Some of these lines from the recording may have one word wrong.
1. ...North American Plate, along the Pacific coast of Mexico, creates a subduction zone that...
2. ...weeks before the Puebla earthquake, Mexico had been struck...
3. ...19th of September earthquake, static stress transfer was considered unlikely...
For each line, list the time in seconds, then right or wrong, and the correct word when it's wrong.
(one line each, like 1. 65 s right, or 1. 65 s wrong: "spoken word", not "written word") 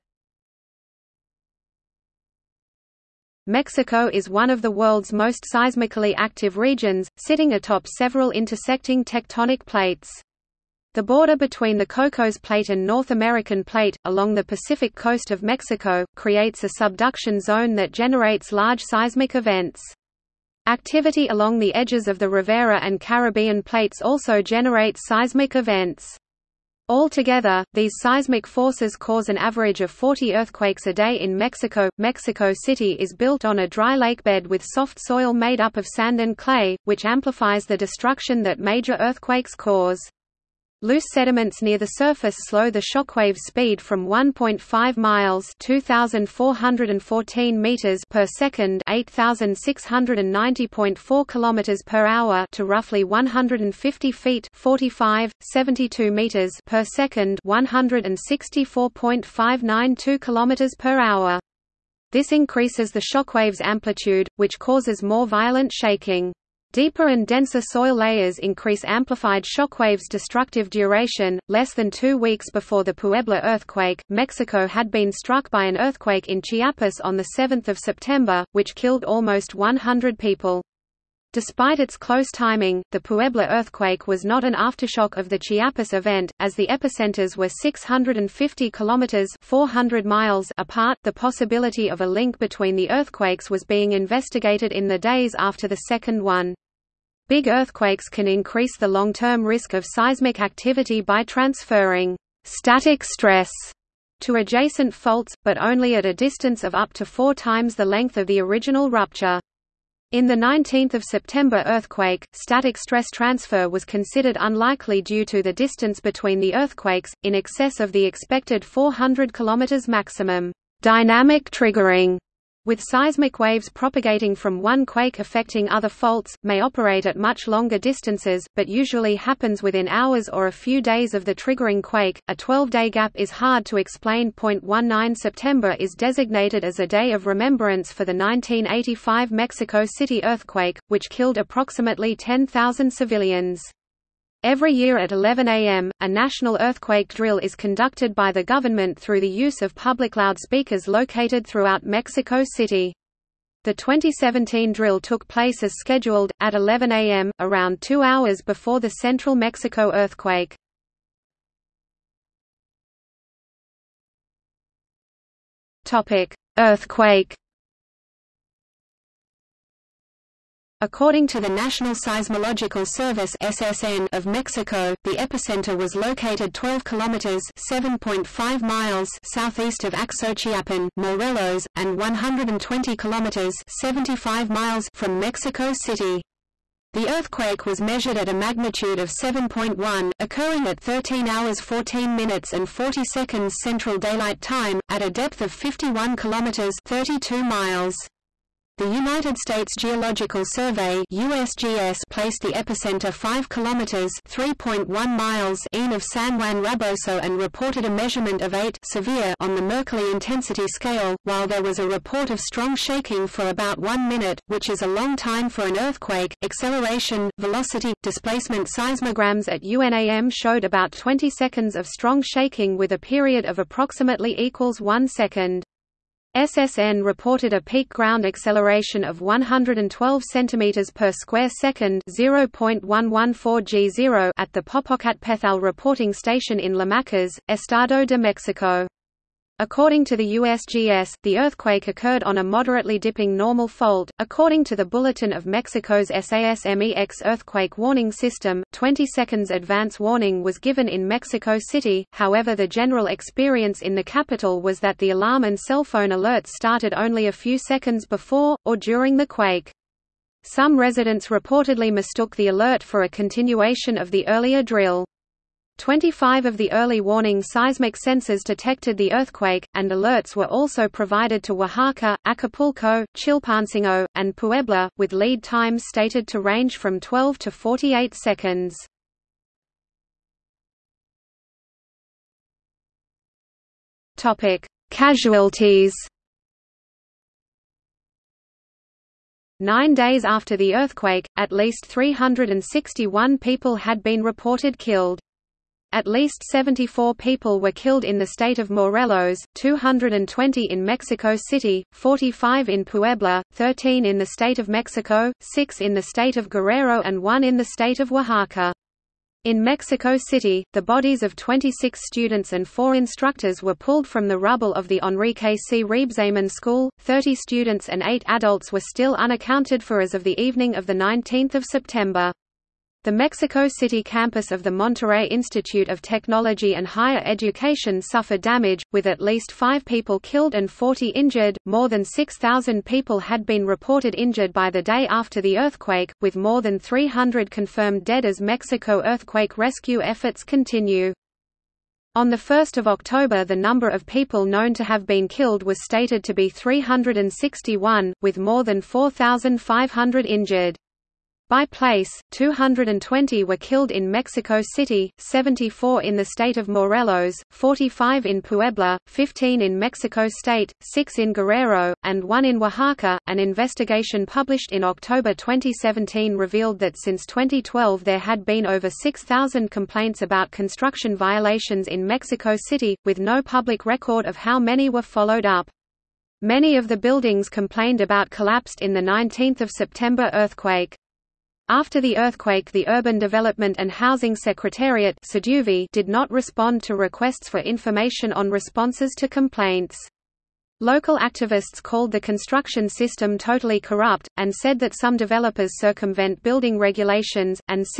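1. 12 s right
2. 72 s right
3. 110 s right.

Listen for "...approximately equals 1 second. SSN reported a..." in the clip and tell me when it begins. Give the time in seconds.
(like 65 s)
223 s.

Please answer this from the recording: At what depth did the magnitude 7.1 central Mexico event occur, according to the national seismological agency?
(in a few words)
51 kilometers.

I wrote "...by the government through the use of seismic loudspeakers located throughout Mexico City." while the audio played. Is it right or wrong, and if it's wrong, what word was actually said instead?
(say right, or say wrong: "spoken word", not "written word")
wrong: "public", not "seismic".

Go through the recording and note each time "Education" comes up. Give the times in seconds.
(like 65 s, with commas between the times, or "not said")
327 s.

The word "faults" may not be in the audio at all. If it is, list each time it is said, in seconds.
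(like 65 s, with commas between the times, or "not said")
104 s, 125 s, 243 s.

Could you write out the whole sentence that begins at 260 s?
Some residents reportedly mistook the alert for a continuation of the earlier drill.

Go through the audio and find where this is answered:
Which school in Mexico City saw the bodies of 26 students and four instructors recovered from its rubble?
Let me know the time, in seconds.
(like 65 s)
315 s.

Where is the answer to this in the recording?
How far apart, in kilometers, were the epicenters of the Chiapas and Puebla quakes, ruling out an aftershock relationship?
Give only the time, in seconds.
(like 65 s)
87 s.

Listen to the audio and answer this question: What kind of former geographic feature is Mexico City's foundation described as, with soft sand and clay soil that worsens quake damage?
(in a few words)
a dry lakebed.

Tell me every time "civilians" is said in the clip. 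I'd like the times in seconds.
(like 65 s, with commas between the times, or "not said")
142 s.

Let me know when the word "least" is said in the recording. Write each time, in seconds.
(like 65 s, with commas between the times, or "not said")
291 s, 296 s, 329 s.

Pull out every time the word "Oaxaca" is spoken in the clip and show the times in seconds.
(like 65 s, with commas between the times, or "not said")
271 s, 308 s, 362 s.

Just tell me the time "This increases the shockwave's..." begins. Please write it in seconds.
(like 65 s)
62 s.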